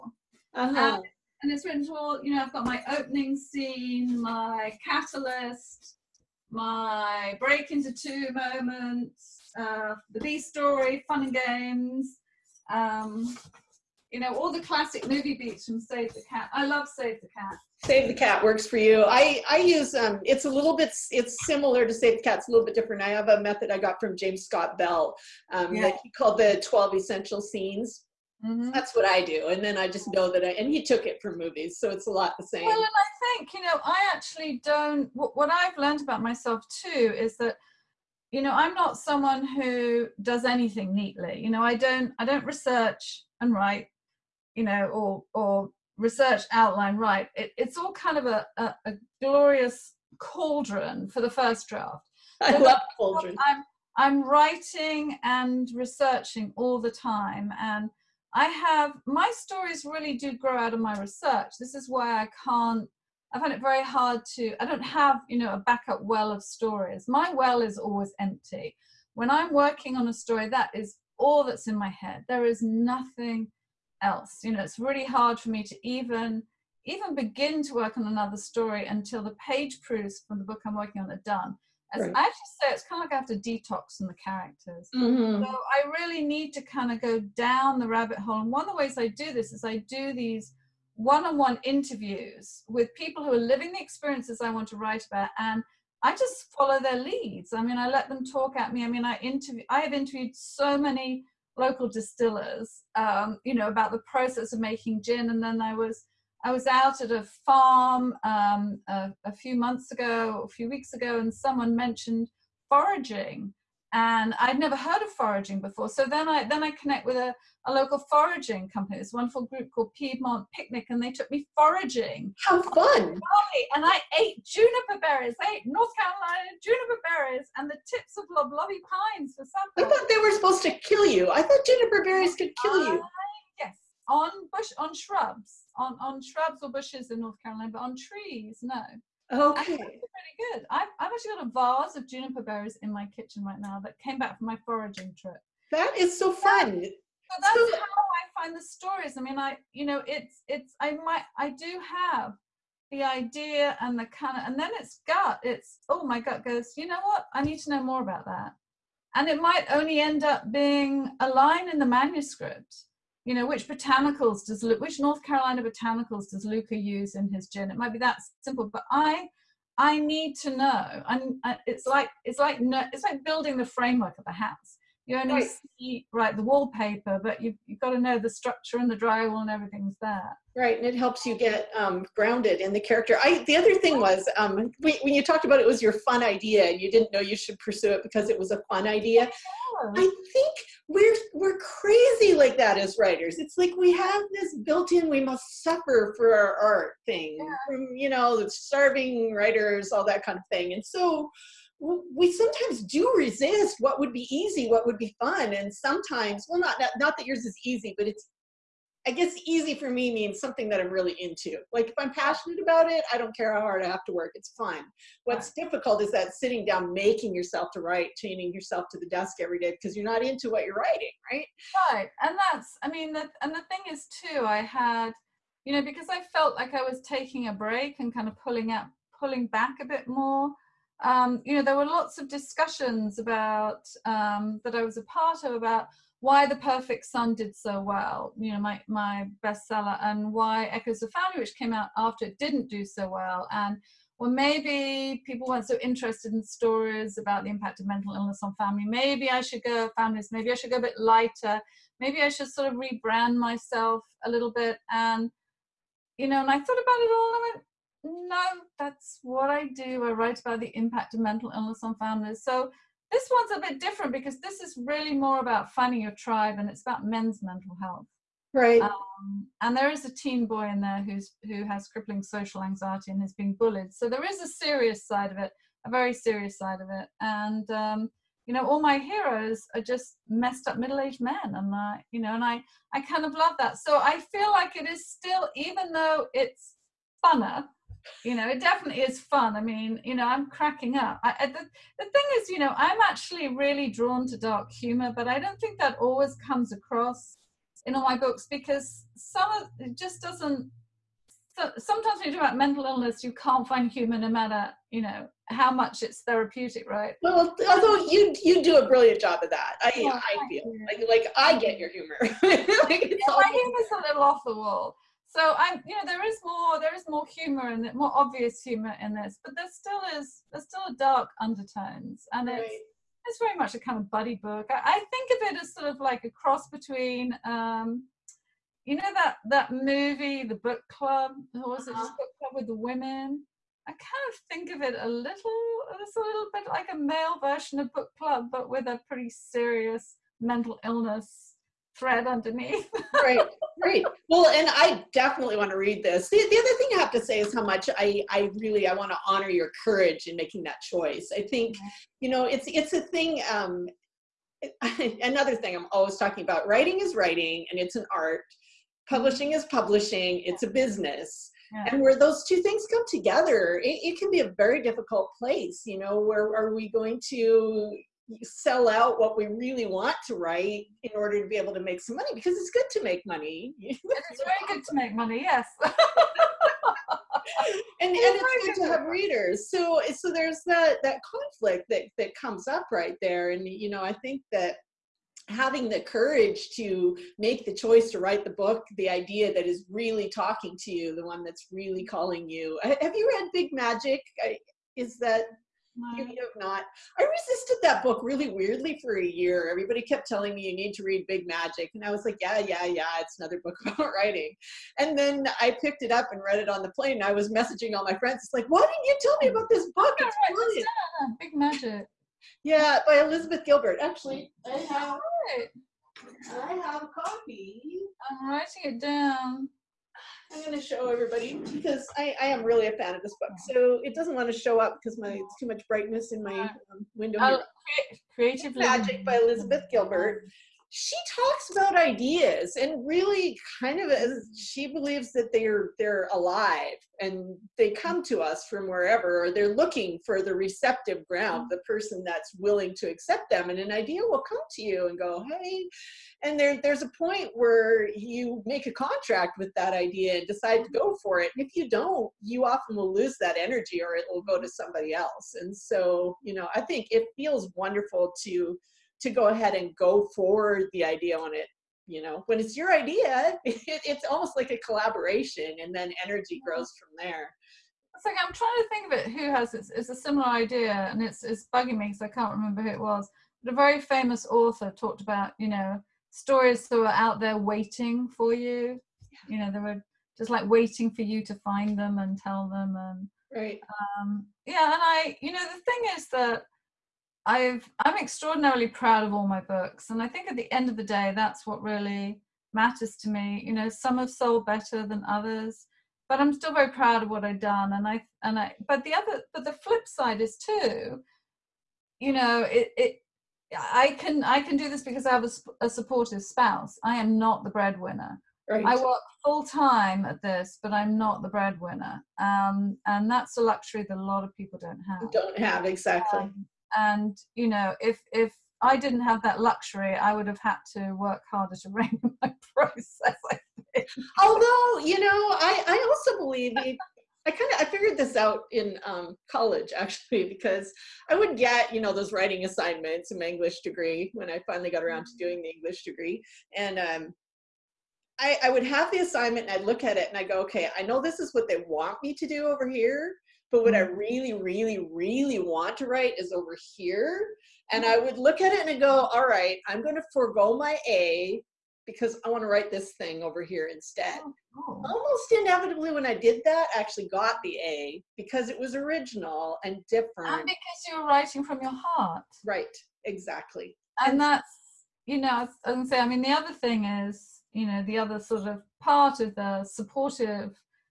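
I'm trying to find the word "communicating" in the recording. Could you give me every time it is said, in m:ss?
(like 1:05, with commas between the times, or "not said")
not said.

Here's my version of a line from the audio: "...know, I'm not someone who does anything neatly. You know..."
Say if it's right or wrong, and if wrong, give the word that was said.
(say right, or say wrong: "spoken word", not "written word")
right.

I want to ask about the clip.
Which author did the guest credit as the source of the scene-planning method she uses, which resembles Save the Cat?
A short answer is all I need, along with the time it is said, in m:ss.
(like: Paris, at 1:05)
James Scott Bell, at 0:24.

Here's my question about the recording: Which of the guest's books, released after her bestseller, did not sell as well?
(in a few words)
Echoes of Family.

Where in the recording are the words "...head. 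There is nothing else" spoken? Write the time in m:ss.
1:11.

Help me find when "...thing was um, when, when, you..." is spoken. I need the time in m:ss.
3:03.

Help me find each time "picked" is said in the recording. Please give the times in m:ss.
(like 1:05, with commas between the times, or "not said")
6:45.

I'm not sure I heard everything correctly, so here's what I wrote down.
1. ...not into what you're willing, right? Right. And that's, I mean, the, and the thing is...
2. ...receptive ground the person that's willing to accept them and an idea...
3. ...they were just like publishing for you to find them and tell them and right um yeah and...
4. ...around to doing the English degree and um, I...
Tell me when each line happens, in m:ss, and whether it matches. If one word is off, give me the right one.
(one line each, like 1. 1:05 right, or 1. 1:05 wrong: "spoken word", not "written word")
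1. 3:40 wrong: "writing", not "willing"
2. 7:20 right
3. 7:59 wrong: "waiting", not "publishing"
4. 8:55 right.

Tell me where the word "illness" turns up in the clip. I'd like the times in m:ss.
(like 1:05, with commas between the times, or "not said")
4:08, 4:21, 5:02, 5:40.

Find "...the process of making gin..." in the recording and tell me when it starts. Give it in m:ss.
1:43.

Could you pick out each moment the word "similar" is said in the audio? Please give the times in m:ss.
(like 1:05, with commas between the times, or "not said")
0:21, 7:50.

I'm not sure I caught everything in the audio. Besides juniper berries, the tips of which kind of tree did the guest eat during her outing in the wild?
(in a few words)
loblolly pines.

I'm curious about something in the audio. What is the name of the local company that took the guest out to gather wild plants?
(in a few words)
Piedmont Picnic.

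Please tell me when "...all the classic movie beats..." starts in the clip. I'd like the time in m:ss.
0:14.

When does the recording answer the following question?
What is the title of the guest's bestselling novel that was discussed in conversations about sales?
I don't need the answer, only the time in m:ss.
3:56.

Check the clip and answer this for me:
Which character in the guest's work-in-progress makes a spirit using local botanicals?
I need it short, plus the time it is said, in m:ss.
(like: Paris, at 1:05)
Luca, at 2:46.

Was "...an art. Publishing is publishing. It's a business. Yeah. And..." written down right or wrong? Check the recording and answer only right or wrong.
right.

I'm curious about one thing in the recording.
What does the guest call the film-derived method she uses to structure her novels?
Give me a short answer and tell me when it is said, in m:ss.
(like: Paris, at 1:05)
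12 essential scenes, at 0:26.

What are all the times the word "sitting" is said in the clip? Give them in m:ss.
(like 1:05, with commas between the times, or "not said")
3:36.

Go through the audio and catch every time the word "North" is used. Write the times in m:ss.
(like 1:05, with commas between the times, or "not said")
2:05, 2:17, 2:44.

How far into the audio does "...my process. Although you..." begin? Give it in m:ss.
8:42.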